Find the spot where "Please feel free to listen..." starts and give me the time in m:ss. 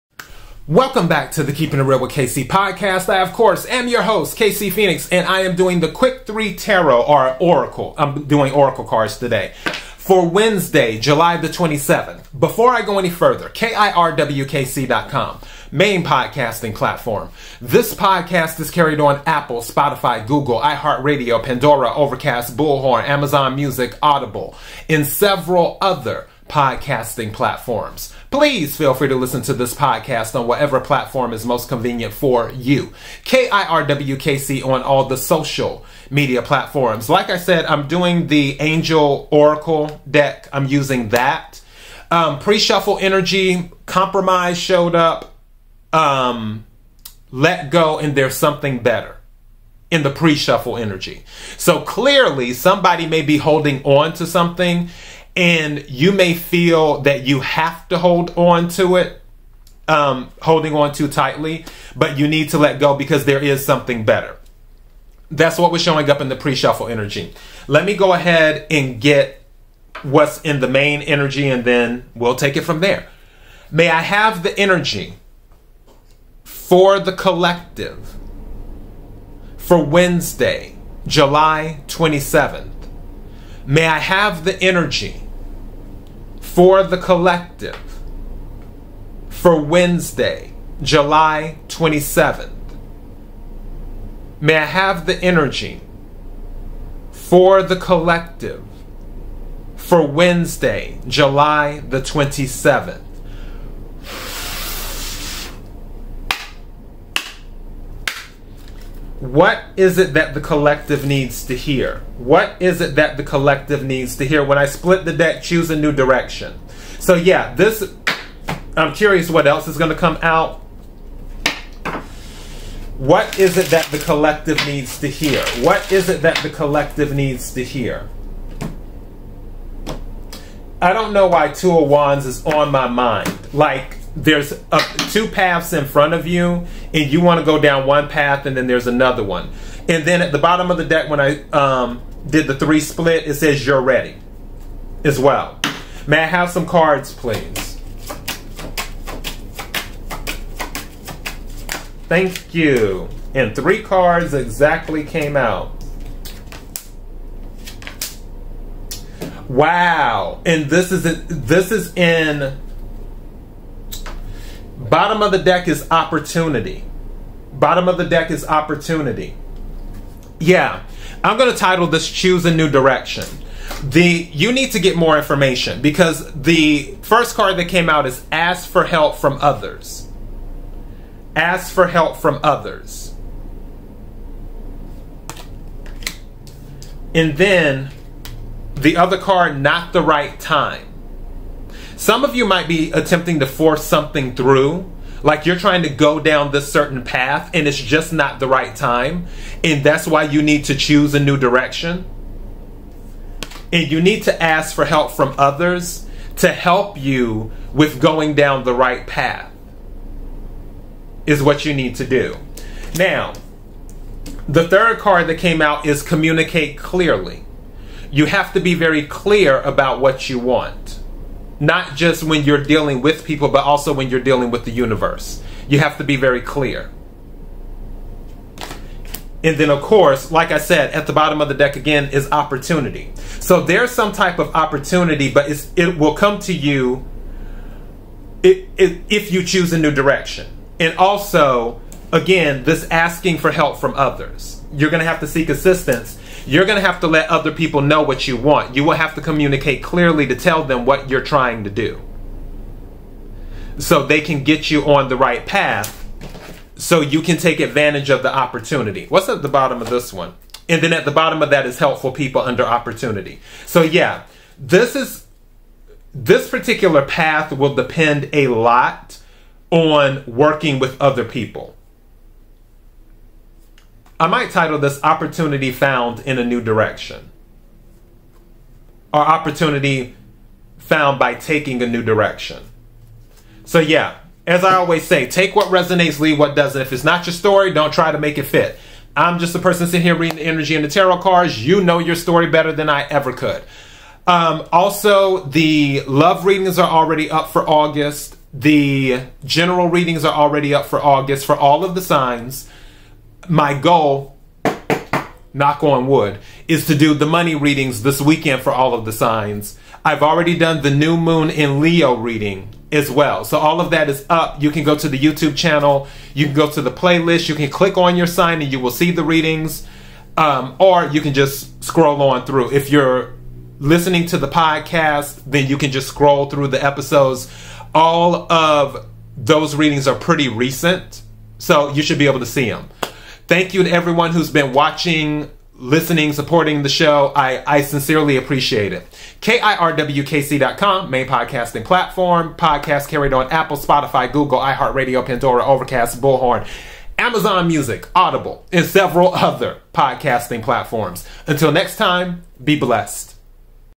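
0:28.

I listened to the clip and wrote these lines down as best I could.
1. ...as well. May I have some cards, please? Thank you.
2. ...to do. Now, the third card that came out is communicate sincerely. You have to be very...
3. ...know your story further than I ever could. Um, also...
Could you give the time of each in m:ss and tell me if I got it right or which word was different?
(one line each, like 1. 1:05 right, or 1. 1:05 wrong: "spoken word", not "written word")
1. 2:25 right
2. 3:31 wrong: "clearly", not "sincerely"
3. 4:51 wrong: "better", not "further".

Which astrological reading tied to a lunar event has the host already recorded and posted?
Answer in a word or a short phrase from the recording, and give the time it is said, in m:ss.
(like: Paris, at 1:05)
New moon in Leo, at 5:10.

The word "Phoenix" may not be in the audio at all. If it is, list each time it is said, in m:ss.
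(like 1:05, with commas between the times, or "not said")
0:04.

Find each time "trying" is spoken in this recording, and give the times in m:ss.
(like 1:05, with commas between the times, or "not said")
3:15, 4:11.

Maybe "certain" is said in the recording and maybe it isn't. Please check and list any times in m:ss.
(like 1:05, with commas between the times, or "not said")
3:16.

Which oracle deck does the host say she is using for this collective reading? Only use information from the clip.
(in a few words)
Angel Oracle deck.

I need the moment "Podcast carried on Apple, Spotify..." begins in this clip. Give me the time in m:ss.
5:42.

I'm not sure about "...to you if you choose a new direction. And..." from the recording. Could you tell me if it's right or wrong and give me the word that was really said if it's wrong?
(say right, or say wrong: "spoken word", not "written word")
right.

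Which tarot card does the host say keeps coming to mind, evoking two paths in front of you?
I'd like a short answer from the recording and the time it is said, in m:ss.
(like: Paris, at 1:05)
Two of Wands, at 2:11.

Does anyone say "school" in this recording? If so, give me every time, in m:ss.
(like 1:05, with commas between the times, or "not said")
not said.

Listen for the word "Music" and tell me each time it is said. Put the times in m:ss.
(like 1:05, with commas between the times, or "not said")
0:23, 5:47.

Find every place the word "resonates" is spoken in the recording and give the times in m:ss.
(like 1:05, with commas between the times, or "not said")
4:45.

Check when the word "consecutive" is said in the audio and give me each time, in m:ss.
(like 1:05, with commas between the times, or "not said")
not said.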